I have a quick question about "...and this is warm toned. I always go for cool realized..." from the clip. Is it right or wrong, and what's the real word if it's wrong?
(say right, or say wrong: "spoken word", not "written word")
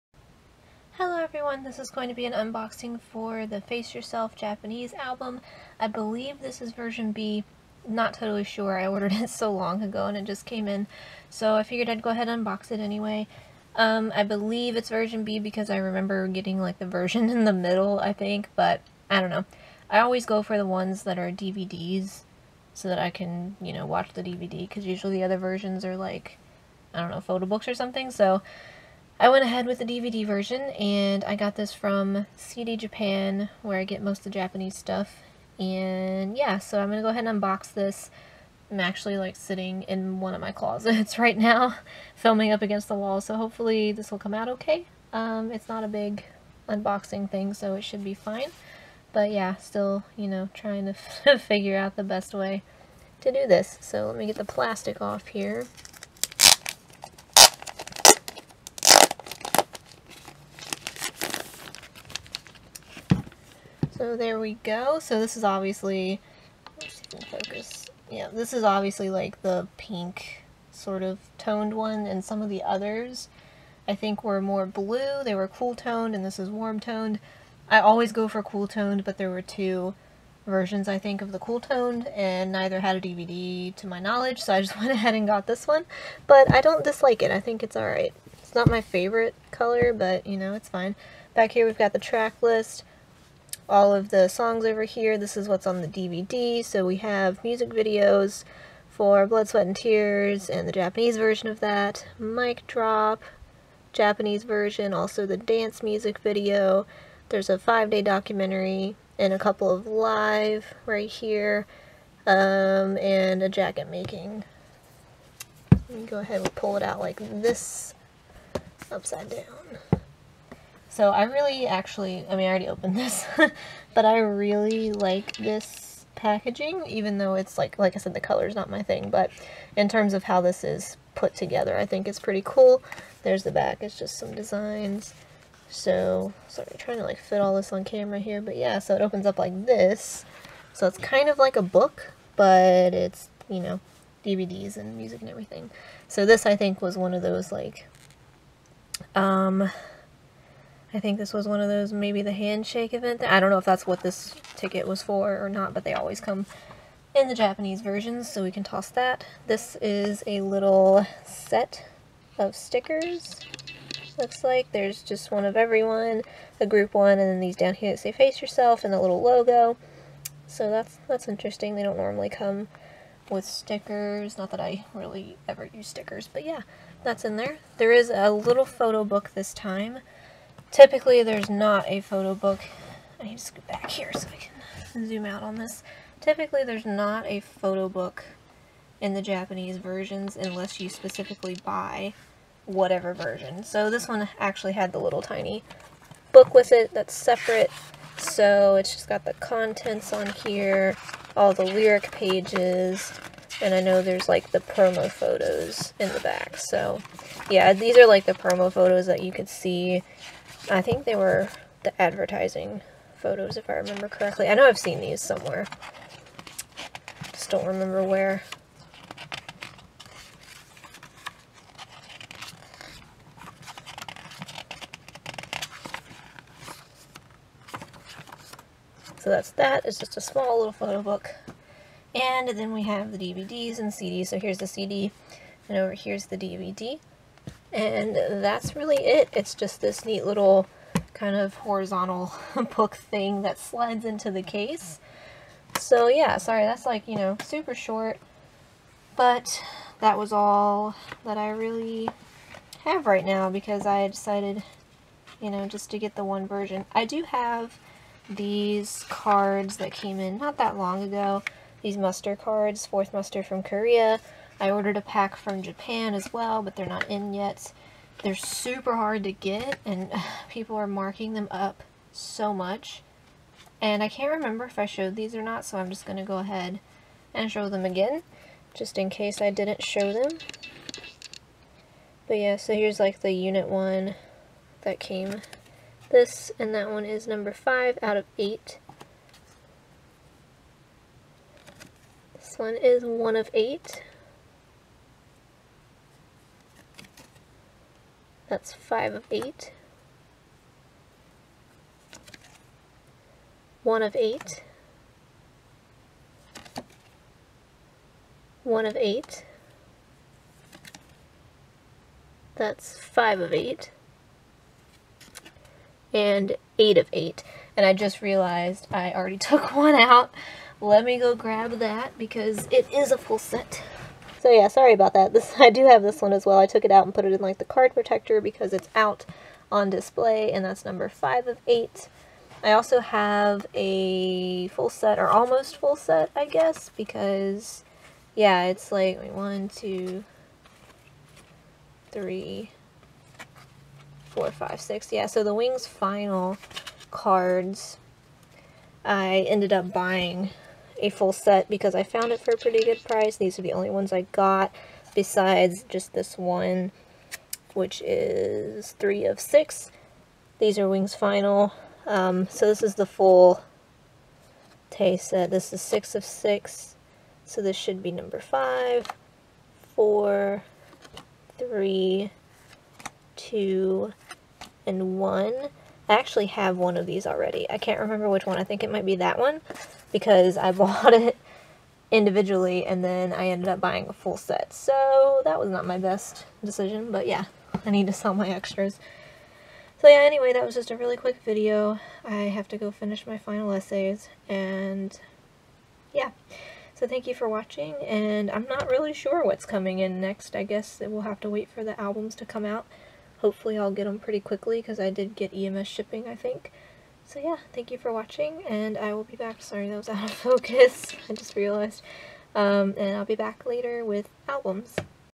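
wrong: "toned", not "realized".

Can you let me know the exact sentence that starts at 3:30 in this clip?
I think they were the advertising photos if I remember correctly.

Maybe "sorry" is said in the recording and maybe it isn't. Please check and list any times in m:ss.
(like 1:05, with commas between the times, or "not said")
2:16, 4:06, 5:24, 6:49.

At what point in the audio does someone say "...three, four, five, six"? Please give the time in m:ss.
5:42.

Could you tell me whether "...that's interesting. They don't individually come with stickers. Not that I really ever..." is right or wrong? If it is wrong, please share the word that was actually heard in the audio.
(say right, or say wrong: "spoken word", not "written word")
wrong: "normally", not "individually".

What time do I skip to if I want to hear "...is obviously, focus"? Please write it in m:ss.
1:05.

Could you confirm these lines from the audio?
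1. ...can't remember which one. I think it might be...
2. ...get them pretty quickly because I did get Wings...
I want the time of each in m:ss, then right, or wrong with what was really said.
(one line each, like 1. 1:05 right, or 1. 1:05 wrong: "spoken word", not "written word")
1. 6:17 right
2. 6:43 wrong: "EMS", not "Wings".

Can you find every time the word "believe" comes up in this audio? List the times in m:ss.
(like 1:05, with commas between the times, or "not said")
0:05, 0:14.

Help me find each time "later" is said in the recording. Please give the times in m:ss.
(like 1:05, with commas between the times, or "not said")
6:53.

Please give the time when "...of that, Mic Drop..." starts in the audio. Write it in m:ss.
1:41.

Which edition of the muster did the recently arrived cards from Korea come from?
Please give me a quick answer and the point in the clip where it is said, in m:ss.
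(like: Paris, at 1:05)
Fourth muster, at 4:22.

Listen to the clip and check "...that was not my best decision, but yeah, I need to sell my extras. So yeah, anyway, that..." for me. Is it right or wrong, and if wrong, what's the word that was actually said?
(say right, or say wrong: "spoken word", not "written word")
right.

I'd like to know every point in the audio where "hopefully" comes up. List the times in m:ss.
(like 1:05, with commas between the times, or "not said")
0:43, 6:43.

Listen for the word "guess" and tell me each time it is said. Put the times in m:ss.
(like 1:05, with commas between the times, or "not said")
5:36, 6:40.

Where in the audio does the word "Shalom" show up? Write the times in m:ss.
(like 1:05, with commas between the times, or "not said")
not said.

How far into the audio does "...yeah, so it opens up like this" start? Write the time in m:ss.
2:18.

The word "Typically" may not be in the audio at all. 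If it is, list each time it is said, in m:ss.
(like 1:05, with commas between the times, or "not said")
3:00, 3:06.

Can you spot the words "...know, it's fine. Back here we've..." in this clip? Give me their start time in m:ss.
1:30.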